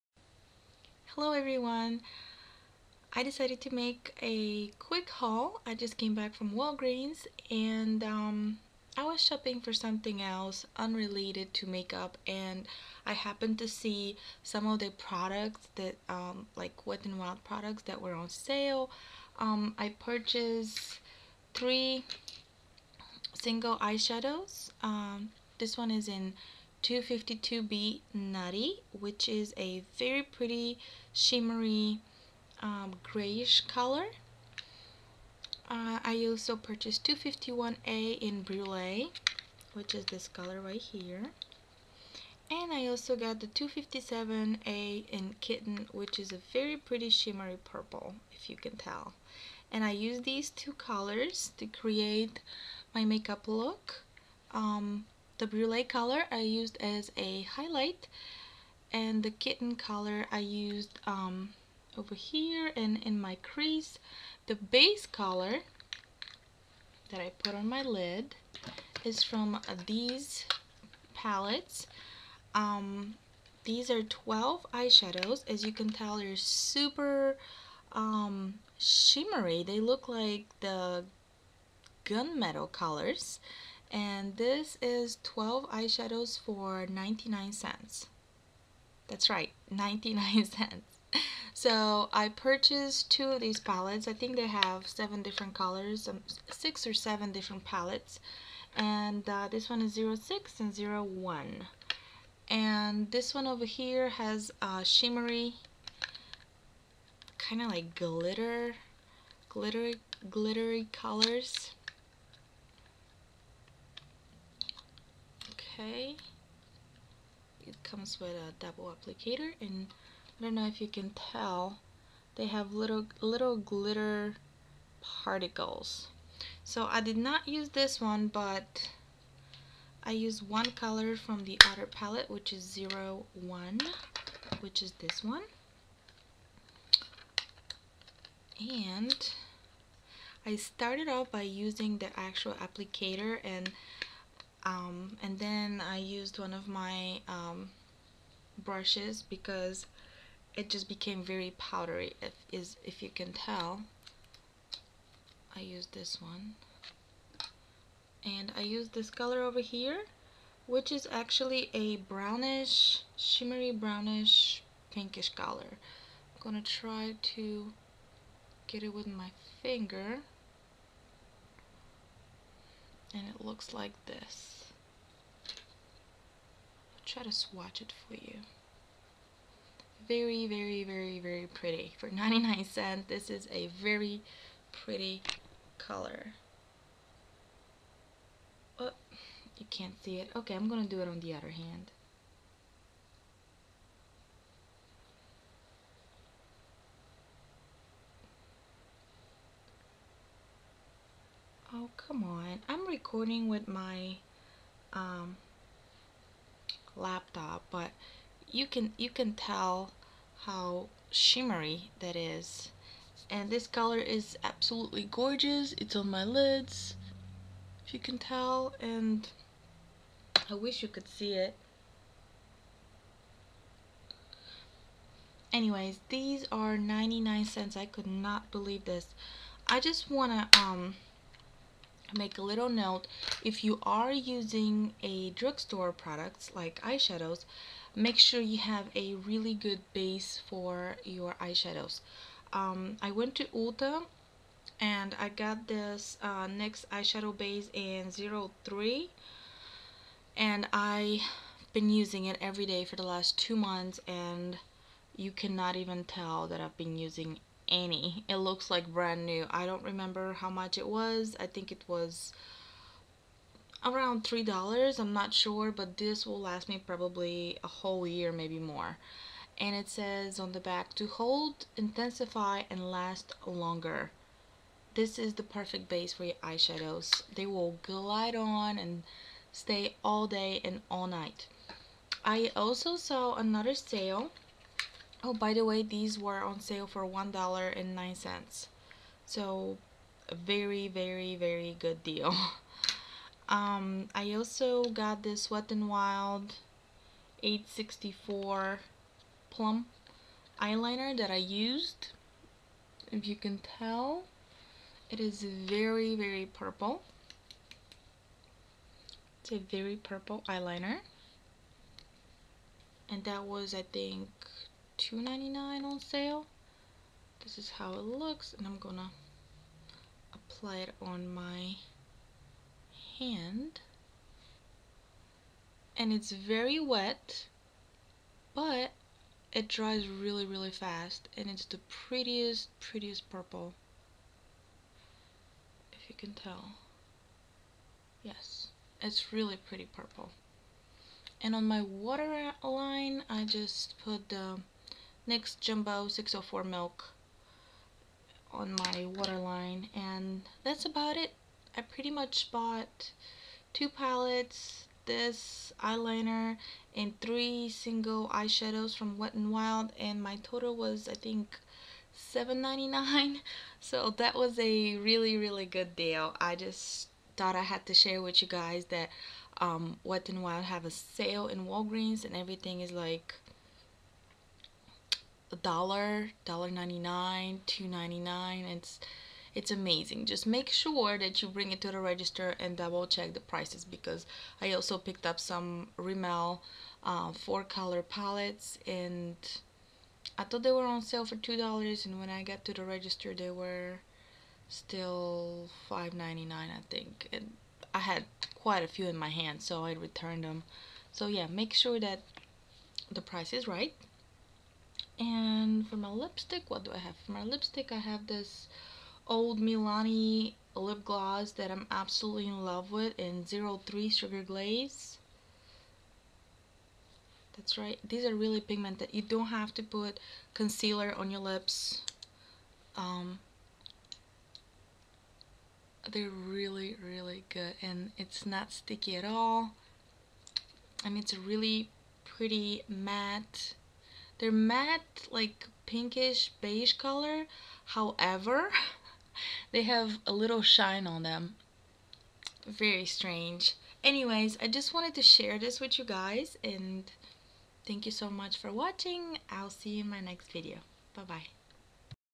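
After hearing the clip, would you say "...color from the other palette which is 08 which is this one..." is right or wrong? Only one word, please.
wrong.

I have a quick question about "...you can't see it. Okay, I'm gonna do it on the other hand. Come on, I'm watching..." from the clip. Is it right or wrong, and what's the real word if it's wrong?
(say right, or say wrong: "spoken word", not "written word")
wrong: "recording", not "watching".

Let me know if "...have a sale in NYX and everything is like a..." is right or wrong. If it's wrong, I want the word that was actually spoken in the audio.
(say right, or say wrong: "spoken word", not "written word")
wrong: "Walgreens", not "NYX".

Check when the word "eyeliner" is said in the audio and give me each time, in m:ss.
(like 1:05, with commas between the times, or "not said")
5:00, 5:10, 5:55.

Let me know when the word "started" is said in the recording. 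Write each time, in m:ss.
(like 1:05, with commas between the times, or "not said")
2:20.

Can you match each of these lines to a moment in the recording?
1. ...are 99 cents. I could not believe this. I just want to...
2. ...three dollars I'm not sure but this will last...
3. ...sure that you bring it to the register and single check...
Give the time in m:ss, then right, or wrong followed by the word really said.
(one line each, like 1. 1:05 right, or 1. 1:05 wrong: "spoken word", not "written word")
1. 3:46 right
2. 4:24 right
3. 6:20 wrong: "double", not "single".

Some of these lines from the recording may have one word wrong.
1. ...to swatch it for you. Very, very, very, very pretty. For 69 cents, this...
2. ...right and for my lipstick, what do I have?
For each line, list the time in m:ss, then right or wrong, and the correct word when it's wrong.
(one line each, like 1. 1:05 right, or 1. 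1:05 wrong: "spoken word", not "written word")
1. 2:57 wrong: "99", not "69"
2. 6:43 right.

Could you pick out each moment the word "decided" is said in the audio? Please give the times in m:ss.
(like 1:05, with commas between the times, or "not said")
0:03.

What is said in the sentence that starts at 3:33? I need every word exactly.
And this color is absolutely gorgeous.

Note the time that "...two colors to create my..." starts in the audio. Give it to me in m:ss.
0:50.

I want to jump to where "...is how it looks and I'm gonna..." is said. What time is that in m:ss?
5:17.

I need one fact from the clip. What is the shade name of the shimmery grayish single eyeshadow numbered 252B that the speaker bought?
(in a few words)
Nutty.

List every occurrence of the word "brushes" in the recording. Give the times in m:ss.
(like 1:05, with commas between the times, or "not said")
2:28.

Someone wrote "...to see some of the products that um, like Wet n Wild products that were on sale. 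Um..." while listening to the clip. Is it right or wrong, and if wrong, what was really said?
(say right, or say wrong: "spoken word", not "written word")
right.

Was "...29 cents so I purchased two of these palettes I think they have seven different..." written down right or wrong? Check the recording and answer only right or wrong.
wrong.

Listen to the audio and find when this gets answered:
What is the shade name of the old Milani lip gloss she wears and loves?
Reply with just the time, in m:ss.
6:54.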